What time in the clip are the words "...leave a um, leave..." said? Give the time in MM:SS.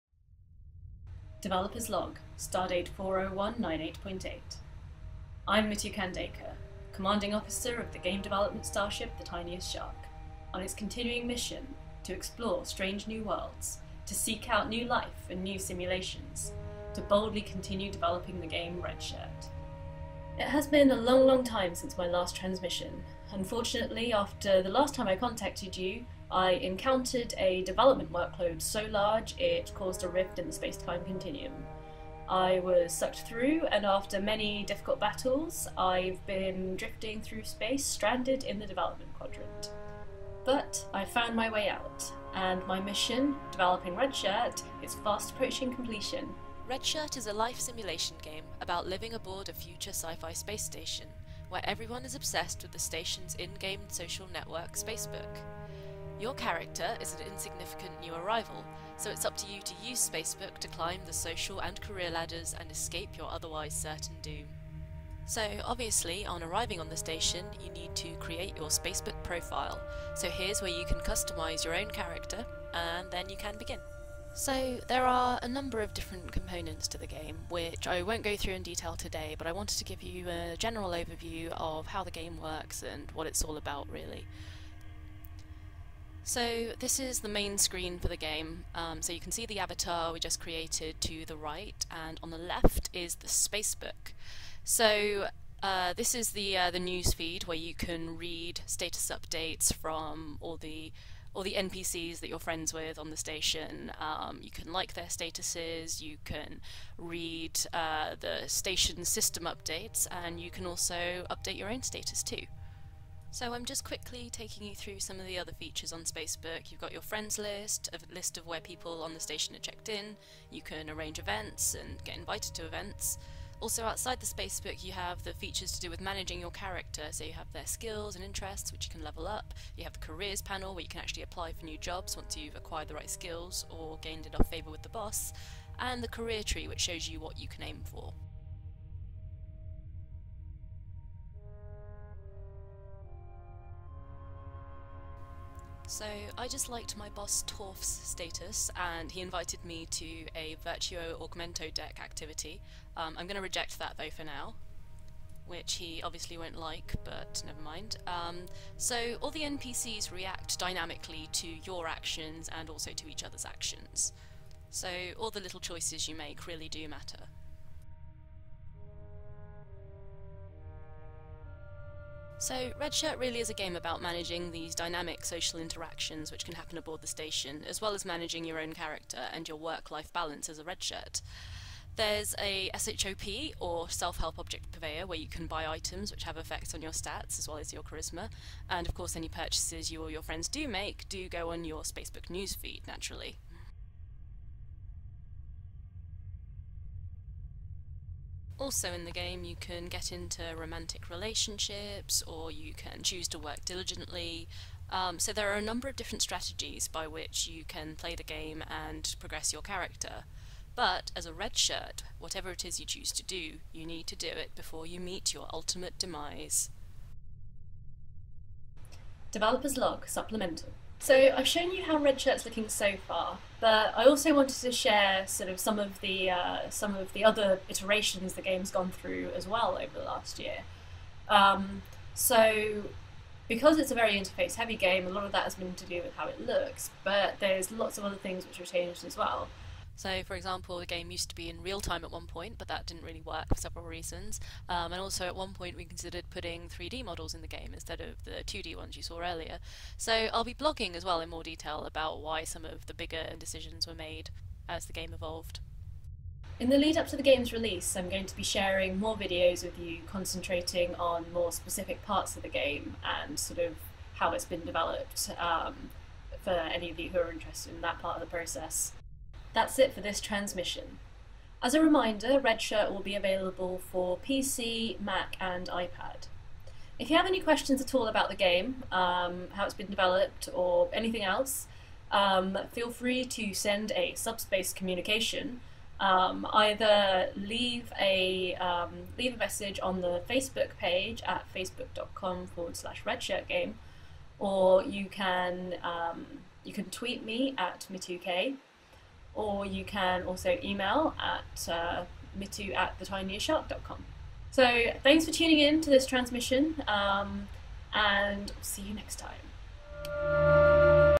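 04:47.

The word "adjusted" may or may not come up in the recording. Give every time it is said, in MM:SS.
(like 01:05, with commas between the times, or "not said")
not said.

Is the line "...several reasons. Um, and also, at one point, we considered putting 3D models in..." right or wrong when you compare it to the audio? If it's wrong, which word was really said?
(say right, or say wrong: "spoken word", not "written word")
right.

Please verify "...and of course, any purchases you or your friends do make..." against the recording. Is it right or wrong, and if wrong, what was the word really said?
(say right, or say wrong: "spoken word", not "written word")
right.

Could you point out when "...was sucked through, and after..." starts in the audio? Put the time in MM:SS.
00:32.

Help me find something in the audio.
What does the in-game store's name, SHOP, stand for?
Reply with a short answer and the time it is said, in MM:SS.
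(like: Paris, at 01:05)
Self help object purveyor, at 03:03.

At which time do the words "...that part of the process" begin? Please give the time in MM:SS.
04:27.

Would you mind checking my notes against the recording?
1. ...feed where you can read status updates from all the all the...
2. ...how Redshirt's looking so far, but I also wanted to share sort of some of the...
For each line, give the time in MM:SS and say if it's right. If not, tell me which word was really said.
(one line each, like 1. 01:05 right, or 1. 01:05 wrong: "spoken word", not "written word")
1. 01:37 right
2. 03:41 right.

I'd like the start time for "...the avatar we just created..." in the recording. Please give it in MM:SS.
01:29.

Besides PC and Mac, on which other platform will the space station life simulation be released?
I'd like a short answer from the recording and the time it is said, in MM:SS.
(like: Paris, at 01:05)
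iPad, at 04:35.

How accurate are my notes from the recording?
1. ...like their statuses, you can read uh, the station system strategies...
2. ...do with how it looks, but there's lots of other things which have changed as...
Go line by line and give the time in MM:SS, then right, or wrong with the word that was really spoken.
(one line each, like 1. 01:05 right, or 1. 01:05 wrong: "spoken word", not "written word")
1. 01:44 wrong: "updates", not "strategies"
2. 03:55 right.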